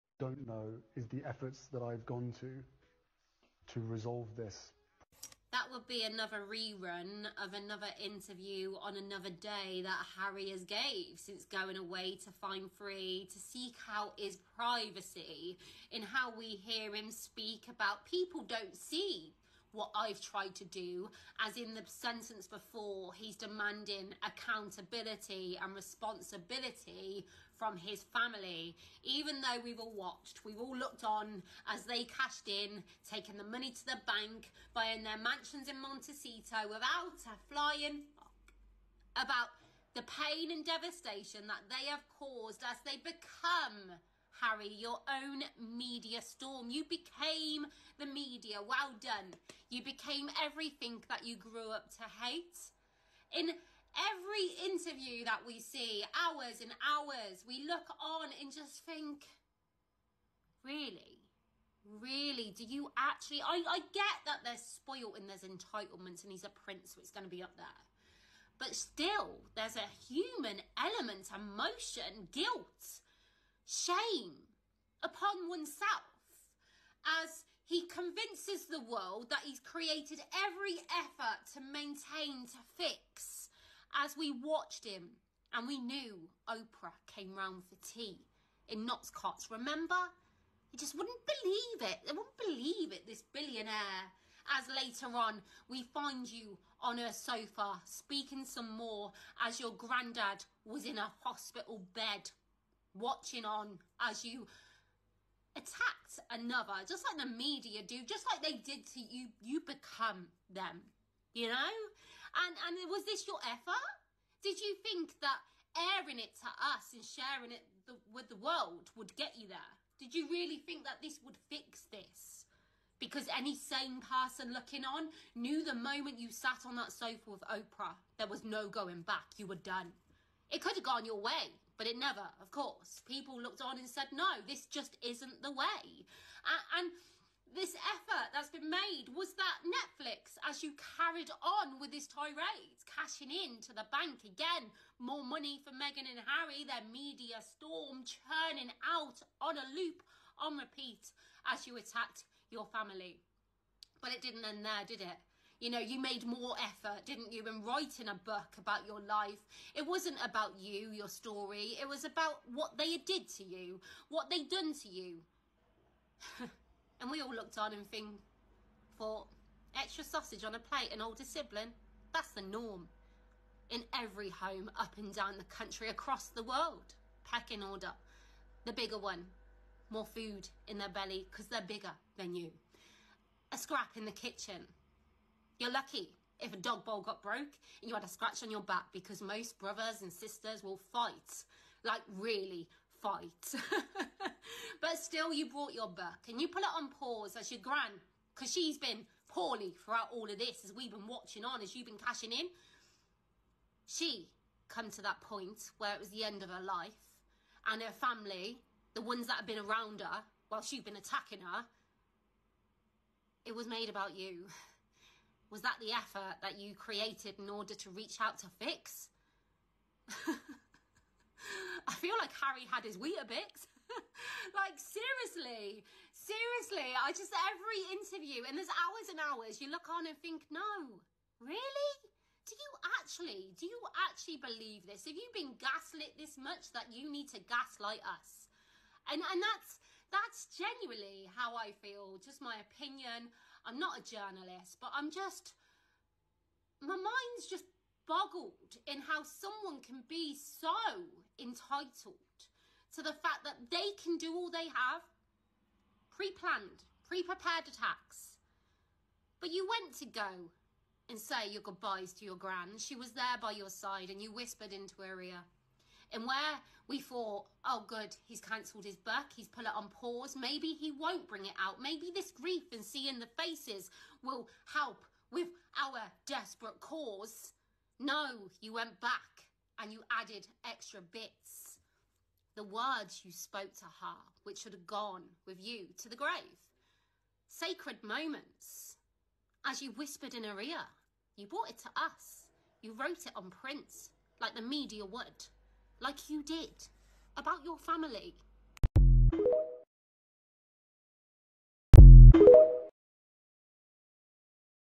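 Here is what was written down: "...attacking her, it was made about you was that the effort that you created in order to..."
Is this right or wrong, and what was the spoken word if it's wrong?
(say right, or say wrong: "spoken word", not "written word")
right.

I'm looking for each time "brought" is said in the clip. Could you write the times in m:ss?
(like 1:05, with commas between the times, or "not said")
3:15, 4:51.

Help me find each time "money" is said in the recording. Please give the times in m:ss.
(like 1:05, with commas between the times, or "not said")
0:33, 2:25.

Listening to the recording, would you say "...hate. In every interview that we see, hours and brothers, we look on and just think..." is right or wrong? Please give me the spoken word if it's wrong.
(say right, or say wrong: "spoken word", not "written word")
wrong: "hours", not "brothers".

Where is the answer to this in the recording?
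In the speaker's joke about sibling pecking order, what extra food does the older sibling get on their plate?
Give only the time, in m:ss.
2:50.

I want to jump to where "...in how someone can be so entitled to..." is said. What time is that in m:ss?
4:08.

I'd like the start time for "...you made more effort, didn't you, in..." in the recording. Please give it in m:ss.
2:35.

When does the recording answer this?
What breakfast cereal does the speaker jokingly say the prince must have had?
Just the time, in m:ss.
3:42.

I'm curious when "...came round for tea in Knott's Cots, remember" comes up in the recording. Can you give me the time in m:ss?
1:27.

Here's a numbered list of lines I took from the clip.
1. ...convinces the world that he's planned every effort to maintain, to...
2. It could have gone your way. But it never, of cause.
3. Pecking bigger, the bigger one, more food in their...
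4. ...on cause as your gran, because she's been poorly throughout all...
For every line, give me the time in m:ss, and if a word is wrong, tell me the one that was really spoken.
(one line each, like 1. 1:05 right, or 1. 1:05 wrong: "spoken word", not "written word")
1. 1:17 wrong: "created", not "planned"
2. 2:10 wrong: "course", not "cause"
3. 2:57 wrong: "order", not "bigger"
4. 3:16 wrong: "pause", not "cause".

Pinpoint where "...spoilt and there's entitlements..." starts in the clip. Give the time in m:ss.
1:04.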